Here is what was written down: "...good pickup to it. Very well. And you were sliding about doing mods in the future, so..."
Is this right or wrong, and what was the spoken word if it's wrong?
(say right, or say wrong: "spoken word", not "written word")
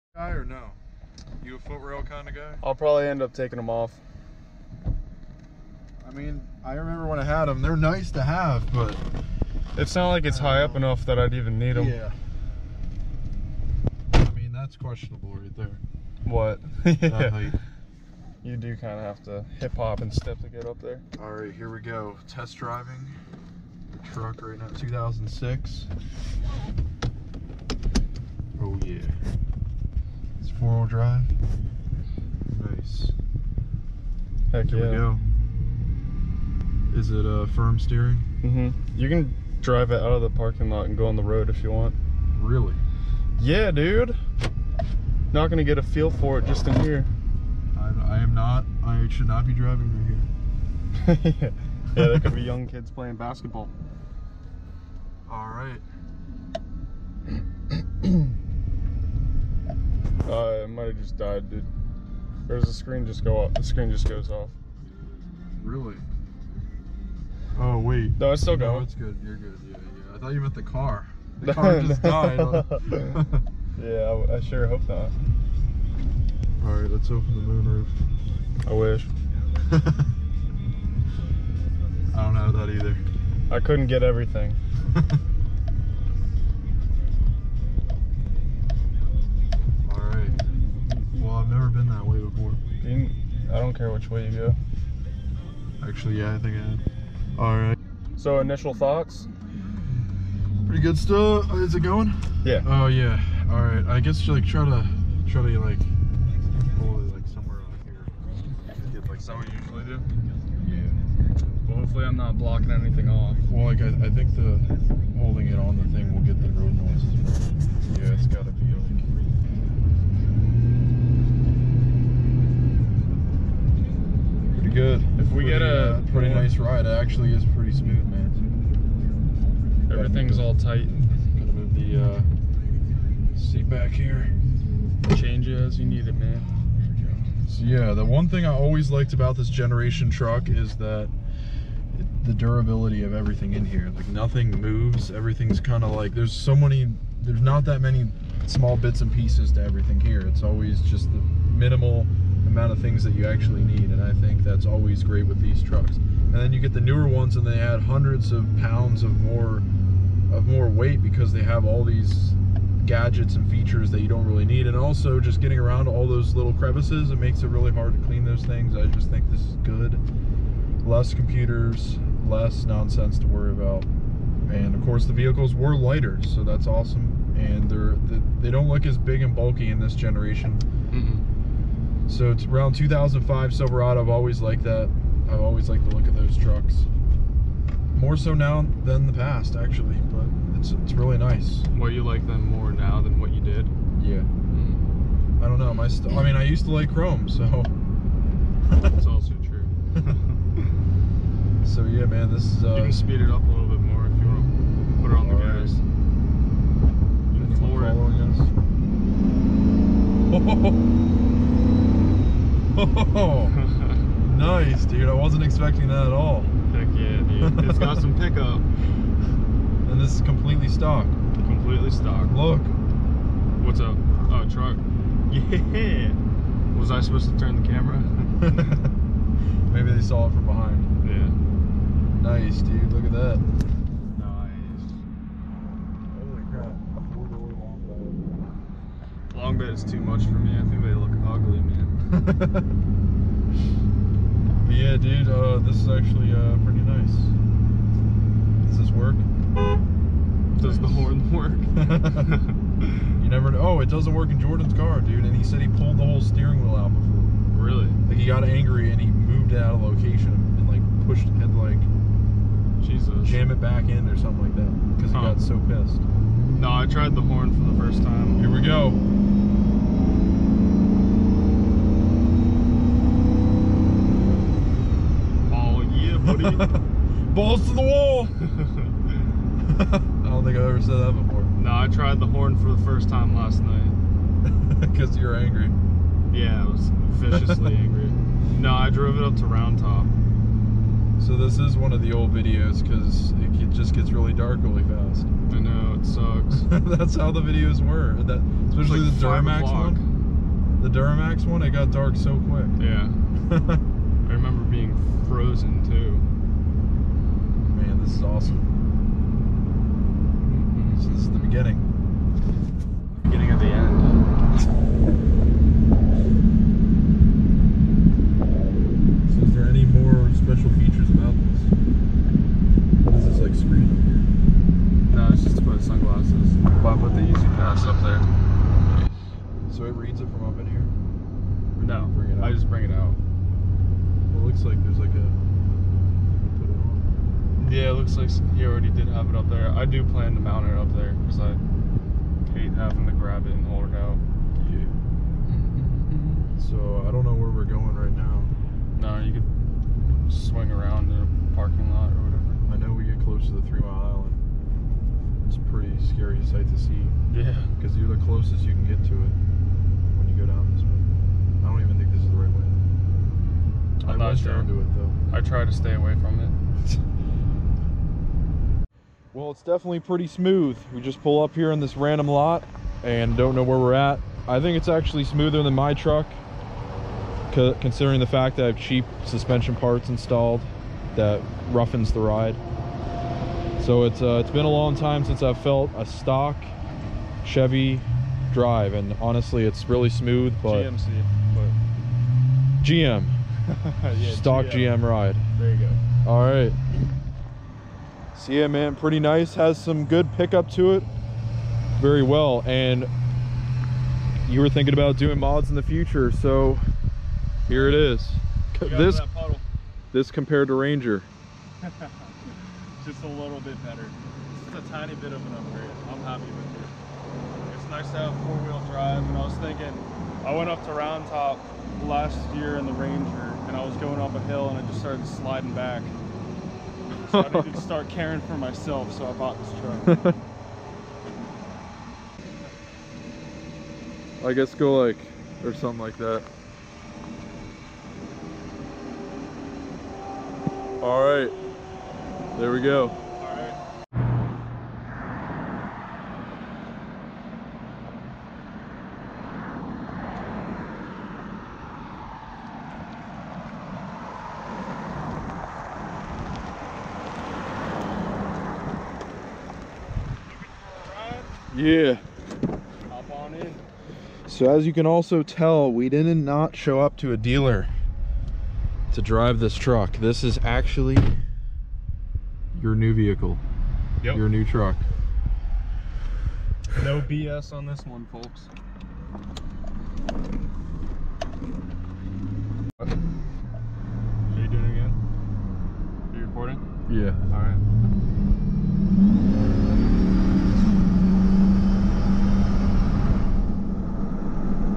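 wrong: "thinking", not "sliding".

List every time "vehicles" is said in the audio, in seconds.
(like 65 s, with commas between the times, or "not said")
175 s, 473 s.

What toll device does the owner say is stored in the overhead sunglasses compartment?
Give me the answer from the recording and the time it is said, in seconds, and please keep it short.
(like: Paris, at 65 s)
Easy Pass, at 327 s.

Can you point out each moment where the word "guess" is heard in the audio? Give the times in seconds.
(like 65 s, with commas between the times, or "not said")
103 s, 434 s.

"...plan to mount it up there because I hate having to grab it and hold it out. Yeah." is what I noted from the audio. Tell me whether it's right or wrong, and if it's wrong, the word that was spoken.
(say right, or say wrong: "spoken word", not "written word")
right.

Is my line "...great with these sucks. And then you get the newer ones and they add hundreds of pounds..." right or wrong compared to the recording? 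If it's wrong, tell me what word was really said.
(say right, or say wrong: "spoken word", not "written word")
wrong: "trucks", not "sucks".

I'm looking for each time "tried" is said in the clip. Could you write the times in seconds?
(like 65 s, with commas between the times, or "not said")
266 s, 281 s.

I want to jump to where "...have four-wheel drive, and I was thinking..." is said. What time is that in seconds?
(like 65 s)
418 s.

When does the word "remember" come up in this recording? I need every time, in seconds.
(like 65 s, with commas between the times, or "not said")
6 s, 304 s.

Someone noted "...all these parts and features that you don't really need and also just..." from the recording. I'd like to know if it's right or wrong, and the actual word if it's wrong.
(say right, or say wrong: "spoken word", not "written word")
wrong: "gadgets", not "parts".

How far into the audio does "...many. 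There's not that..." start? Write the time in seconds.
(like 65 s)
146 s.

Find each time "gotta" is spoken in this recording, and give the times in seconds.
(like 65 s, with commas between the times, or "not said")
118 s, 131 s.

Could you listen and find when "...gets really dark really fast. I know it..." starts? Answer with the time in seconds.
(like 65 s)
293 s.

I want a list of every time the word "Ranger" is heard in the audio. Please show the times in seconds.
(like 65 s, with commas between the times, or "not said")
410 s, 422 s.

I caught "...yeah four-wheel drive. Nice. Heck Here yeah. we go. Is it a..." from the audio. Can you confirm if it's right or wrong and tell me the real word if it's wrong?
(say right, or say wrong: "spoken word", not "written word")
right.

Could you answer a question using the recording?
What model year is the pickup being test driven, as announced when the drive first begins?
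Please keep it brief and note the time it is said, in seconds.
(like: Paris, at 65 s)
2006, at 24 s.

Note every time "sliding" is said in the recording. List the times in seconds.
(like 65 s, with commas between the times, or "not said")
425 s.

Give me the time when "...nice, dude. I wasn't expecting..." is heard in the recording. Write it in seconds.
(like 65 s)
214 s.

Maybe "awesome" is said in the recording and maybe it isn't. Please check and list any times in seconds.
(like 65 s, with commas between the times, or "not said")
176 s, 308 s.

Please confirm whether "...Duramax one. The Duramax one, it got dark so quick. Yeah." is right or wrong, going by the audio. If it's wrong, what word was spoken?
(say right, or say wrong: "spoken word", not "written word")
right.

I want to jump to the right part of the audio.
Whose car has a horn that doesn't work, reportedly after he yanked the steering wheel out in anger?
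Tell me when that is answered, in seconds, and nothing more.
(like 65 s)
254 s.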